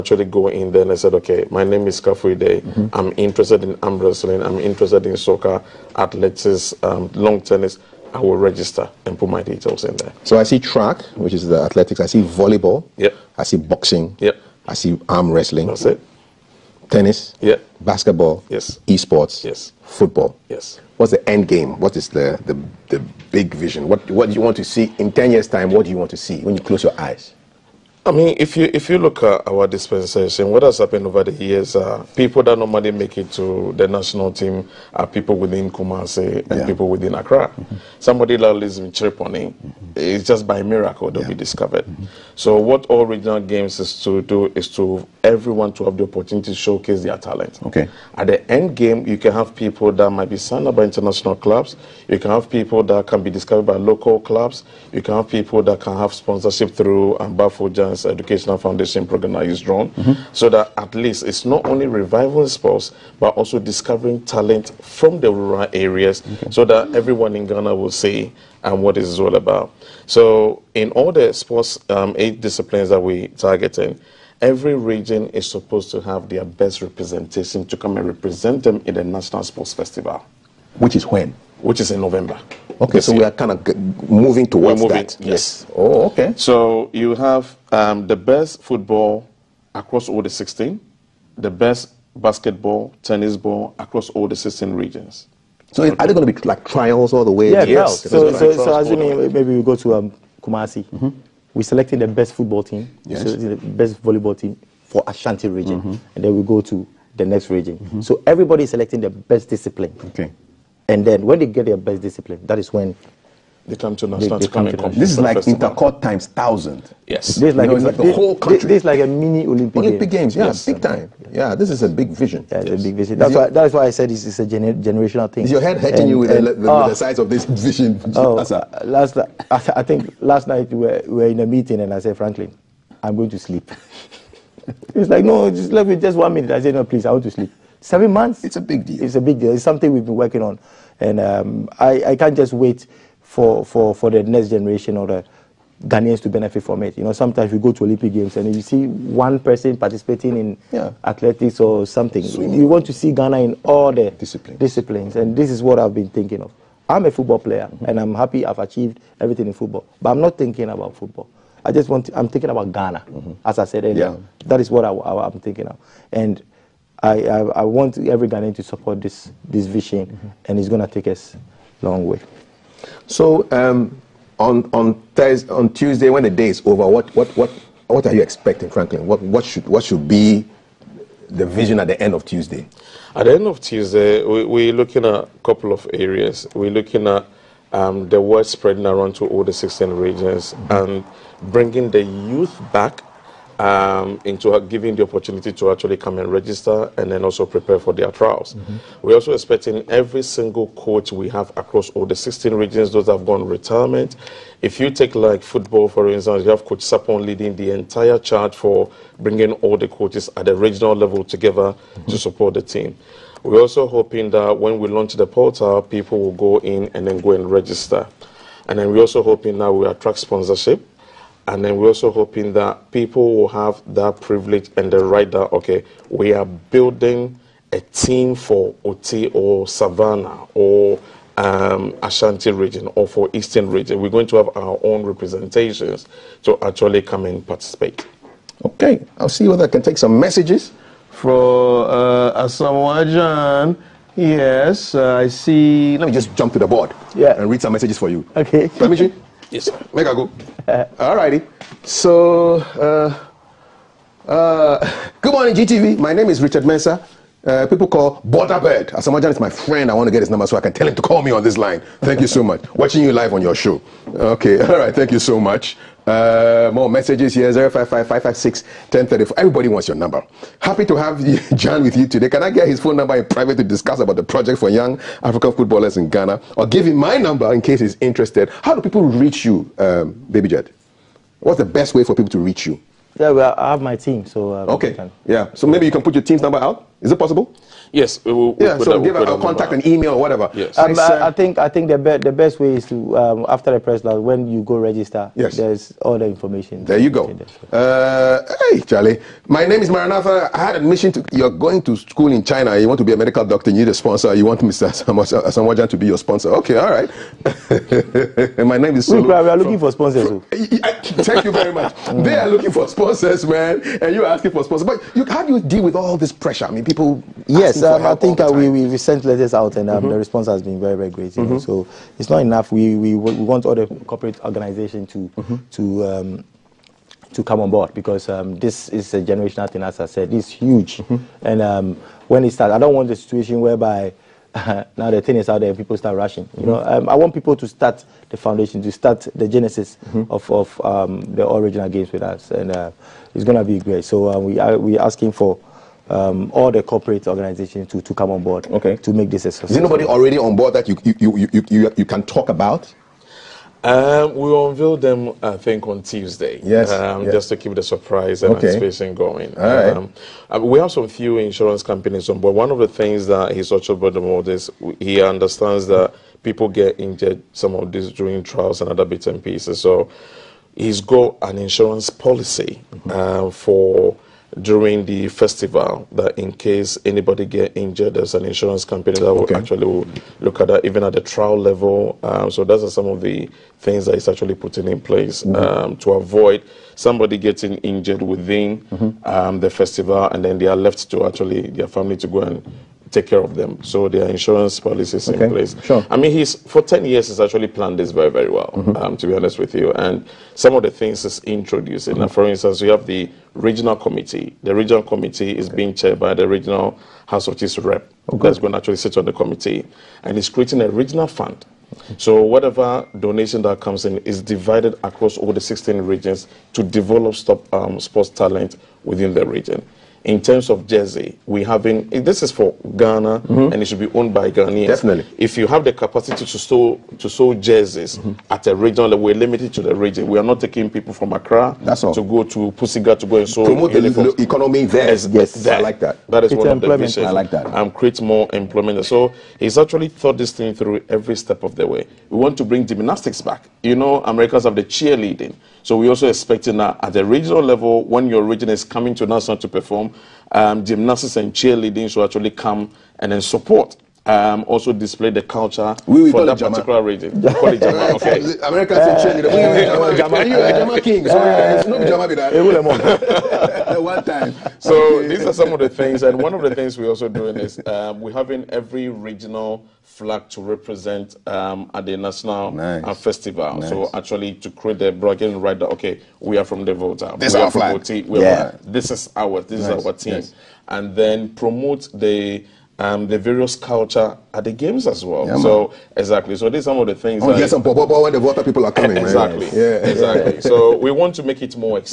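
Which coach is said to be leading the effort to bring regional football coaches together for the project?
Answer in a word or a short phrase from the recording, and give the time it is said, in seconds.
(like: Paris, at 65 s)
Coach Sapon, at 206 s.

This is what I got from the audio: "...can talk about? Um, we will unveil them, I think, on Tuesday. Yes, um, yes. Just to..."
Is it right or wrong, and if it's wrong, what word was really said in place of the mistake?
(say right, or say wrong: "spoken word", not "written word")
right.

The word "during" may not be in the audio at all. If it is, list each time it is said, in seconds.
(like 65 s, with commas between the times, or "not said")
368 s, 374 s.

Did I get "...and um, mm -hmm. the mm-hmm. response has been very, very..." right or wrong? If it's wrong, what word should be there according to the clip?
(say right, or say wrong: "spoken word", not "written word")
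right.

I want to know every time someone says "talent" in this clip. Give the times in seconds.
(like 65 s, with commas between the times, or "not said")
47 s, 64 s, 418 s.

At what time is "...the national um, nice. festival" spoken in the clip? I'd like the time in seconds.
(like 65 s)
472 s.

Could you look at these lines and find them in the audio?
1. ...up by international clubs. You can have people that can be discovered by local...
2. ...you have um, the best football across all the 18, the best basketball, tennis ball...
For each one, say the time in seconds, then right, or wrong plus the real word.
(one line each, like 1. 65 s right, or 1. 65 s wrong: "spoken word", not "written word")
1. 50 s right
2. 86 s wrong: "16", not "18".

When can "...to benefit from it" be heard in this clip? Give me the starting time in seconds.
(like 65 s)
146 s.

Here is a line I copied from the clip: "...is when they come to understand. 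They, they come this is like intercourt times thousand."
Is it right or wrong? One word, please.
right.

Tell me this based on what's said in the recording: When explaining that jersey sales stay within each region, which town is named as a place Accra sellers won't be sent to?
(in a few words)
Pusiga.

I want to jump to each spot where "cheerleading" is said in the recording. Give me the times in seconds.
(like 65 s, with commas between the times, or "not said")
444 s, 451 s.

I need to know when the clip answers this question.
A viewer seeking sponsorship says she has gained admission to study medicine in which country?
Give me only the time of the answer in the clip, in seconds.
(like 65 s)
302 s.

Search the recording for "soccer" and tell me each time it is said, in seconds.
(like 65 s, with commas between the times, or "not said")
5 s.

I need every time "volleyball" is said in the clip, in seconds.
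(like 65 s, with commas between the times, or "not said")
12 s, 104 s.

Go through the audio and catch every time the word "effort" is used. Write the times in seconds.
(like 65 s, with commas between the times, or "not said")
not said.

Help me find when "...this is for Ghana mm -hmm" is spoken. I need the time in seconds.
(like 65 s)
422 s.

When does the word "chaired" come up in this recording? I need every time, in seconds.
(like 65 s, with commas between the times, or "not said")
406 s.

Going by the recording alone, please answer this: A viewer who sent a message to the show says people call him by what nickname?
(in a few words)
Borderbird.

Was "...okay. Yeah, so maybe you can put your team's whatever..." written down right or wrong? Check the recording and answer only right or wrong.
wrong.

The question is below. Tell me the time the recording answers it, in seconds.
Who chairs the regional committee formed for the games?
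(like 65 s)
406 s.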